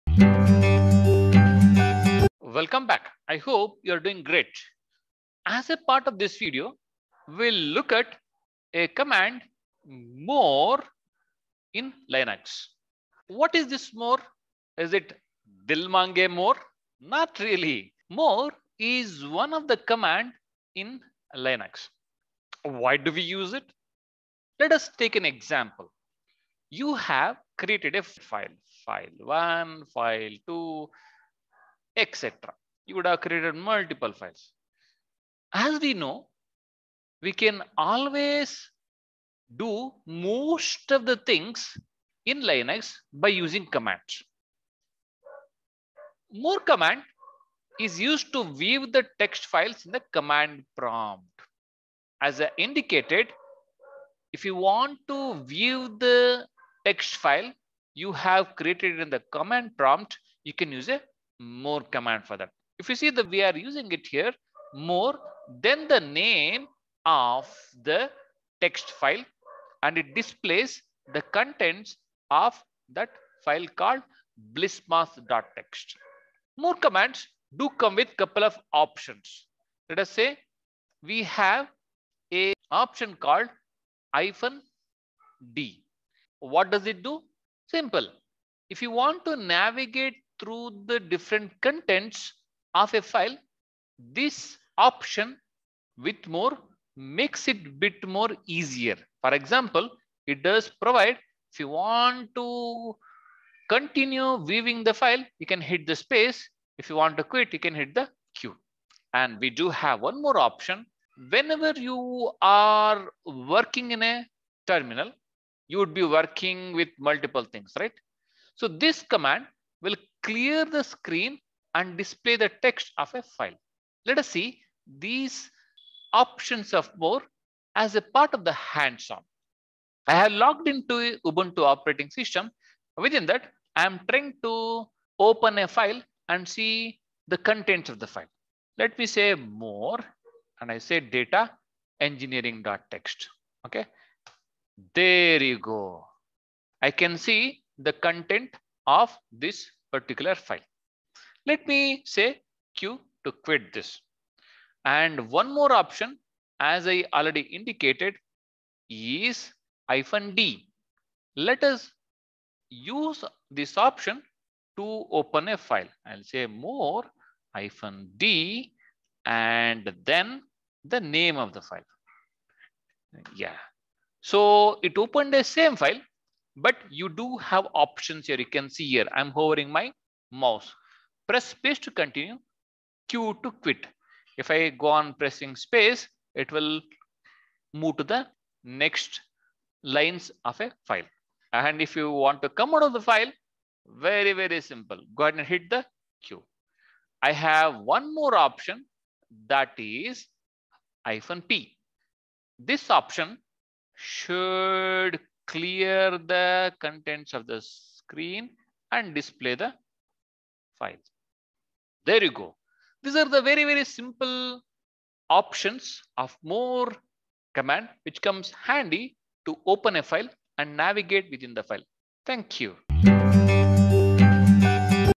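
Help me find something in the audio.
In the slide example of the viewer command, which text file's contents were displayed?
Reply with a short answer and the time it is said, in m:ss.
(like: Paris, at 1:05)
blismos.txt, at 1:14.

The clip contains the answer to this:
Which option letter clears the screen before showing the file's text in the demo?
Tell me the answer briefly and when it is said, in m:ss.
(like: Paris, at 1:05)
-p, at 3:21.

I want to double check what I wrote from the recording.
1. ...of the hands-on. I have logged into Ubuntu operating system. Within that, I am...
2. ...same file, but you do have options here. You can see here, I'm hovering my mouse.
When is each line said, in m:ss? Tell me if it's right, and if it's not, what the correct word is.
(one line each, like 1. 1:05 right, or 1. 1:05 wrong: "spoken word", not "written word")
1. 2:08 right
2. 2:55 right.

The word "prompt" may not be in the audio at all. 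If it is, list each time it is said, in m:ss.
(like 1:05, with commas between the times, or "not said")
0:50, 0:59.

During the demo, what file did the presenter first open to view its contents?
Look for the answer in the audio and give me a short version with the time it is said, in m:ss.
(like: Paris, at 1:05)
data engineering.txt, at 2:20.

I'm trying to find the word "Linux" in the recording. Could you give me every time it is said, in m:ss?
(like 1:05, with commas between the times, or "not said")
0:12, 0:21, 0:42.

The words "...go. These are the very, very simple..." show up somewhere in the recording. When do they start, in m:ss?
3:32.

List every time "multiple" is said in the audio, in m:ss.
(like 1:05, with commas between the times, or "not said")
0:33, 1:57.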